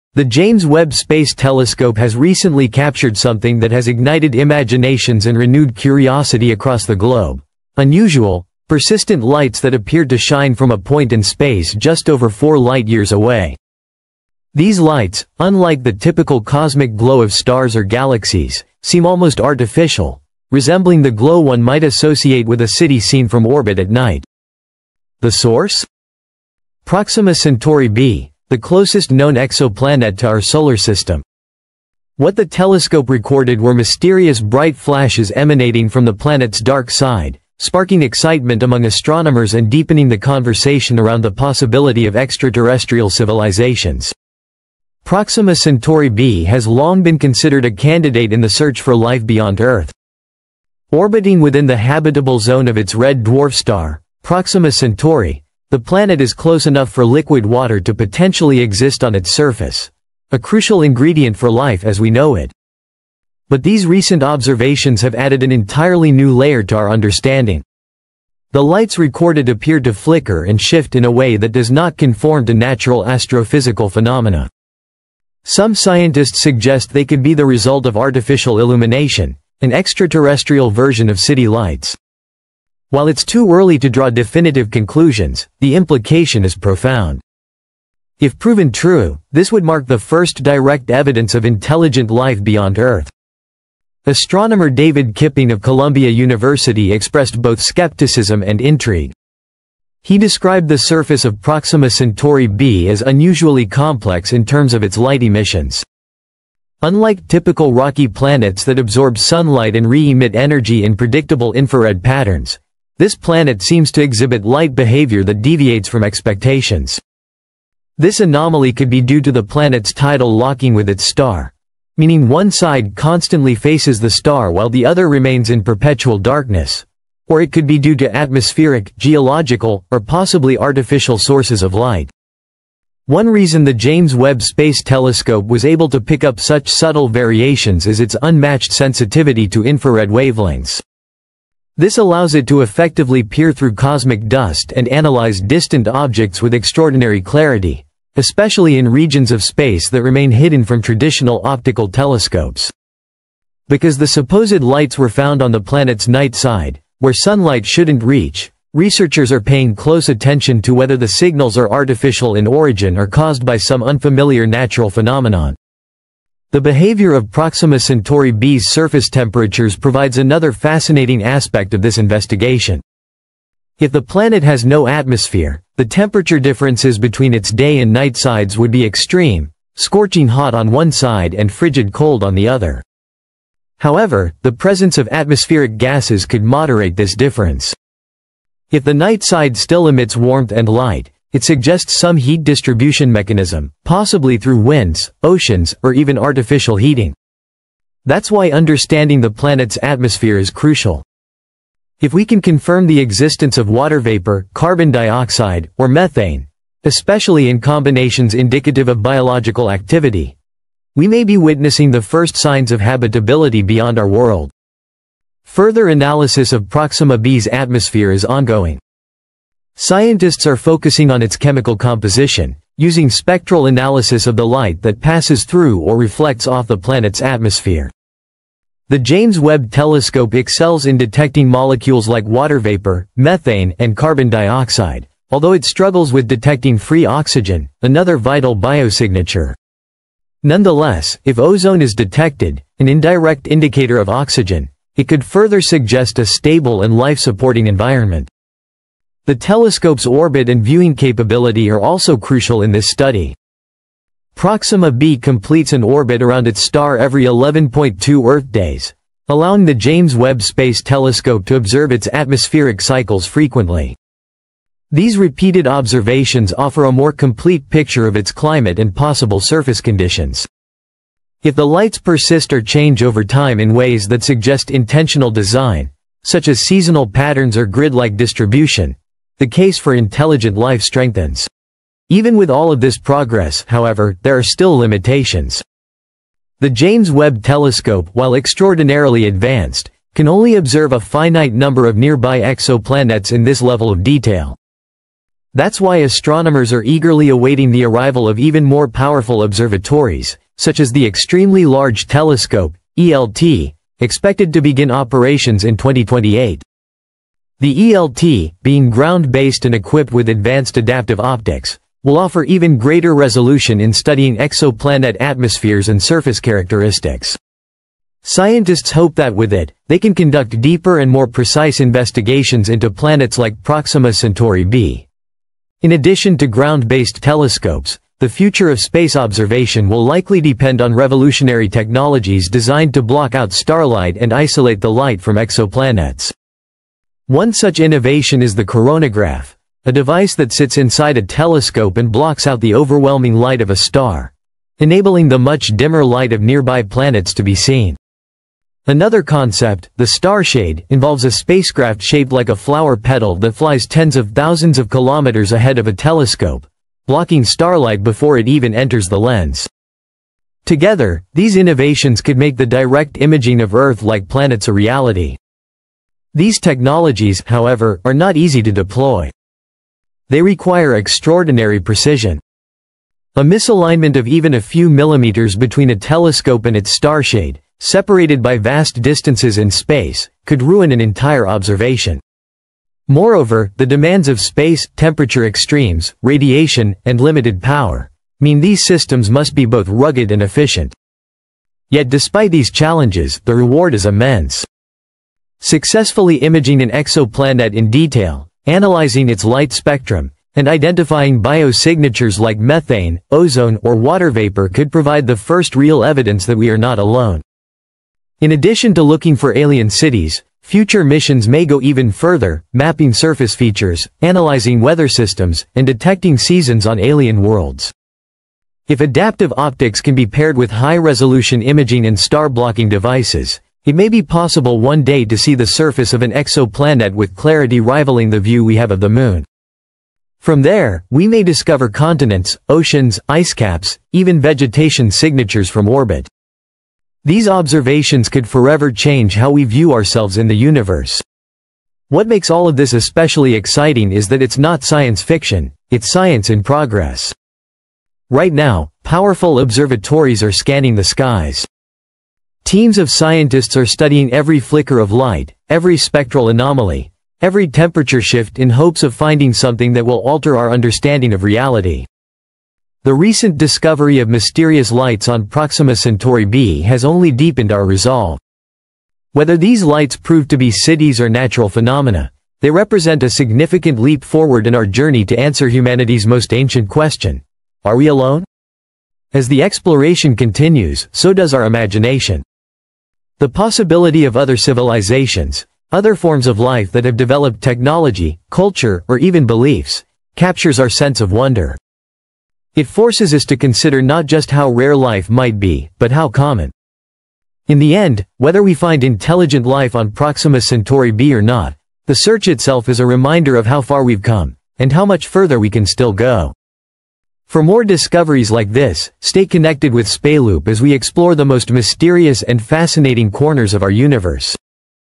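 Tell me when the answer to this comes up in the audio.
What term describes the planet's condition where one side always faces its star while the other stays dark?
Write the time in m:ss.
1:59.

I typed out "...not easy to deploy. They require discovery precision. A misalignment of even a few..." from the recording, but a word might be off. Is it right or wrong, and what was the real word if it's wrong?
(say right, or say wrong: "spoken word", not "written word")
wrong: "extraordinary", not "discovery".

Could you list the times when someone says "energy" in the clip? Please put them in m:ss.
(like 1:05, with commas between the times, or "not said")
1:50.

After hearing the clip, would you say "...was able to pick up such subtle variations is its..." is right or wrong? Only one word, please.
right.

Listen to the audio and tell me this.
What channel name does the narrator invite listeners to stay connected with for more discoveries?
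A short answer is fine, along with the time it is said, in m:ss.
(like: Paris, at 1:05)
SpaceLoop, at 8:30.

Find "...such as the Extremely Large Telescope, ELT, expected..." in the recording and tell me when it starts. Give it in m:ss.
5:00.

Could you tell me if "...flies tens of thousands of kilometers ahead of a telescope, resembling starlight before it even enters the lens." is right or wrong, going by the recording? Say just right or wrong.
wrong.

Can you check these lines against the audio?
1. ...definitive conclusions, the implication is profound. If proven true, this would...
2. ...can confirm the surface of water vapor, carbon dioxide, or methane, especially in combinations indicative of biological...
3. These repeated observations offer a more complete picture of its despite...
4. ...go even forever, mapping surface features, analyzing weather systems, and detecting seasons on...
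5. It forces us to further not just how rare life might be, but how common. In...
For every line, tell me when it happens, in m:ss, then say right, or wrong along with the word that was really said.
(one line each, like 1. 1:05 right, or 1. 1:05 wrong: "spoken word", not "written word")
1. 1:24 right
2. 3:22 wrong: "existence", not "surface"
3. 4:24 wrong: "climate", not "despite"
4. 6:51 wrong: "further", not "forever"
5. 8:12 wrong: "consider", not "further".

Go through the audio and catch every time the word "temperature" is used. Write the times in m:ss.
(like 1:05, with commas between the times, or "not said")
2:49, 2:55, 6:24, 7:37.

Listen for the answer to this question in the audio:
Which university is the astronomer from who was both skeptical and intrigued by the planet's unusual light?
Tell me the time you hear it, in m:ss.
1:35.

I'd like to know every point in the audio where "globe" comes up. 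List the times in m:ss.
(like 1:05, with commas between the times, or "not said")
0:06.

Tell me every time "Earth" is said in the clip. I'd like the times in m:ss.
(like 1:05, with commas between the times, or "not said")
0:49, 1:32, 4:18, 6:03.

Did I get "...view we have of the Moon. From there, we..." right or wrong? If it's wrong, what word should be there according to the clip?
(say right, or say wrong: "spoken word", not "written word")
right.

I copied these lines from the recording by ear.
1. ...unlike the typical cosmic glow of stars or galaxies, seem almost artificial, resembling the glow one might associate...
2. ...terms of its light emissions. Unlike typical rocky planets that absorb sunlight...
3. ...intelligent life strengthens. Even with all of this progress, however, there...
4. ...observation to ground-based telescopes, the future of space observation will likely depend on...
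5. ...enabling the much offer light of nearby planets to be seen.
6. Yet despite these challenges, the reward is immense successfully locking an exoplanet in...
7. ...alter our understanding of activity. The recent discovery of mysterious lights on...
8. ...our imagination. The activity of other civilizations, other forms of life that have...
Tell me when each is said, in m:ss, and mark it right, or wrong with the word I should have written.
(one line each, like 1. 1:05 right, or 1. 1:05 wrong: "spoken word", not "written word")
1. 0:15 right
2. 1:44 right
3. 4:39 right
4. 5:25 wrong: "addition", not "observation"
5. 5:44 wrong: "dimmer", not "offer"
6. 6:31 wrong: "imaging", not "locking"
7. 7:40 wrong: "reality", not "activity"
8. 8:01 wrong: "possibility", not "activity".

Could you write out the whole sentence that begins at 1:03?
But these recent observations have added an entirely new layer to our understanding.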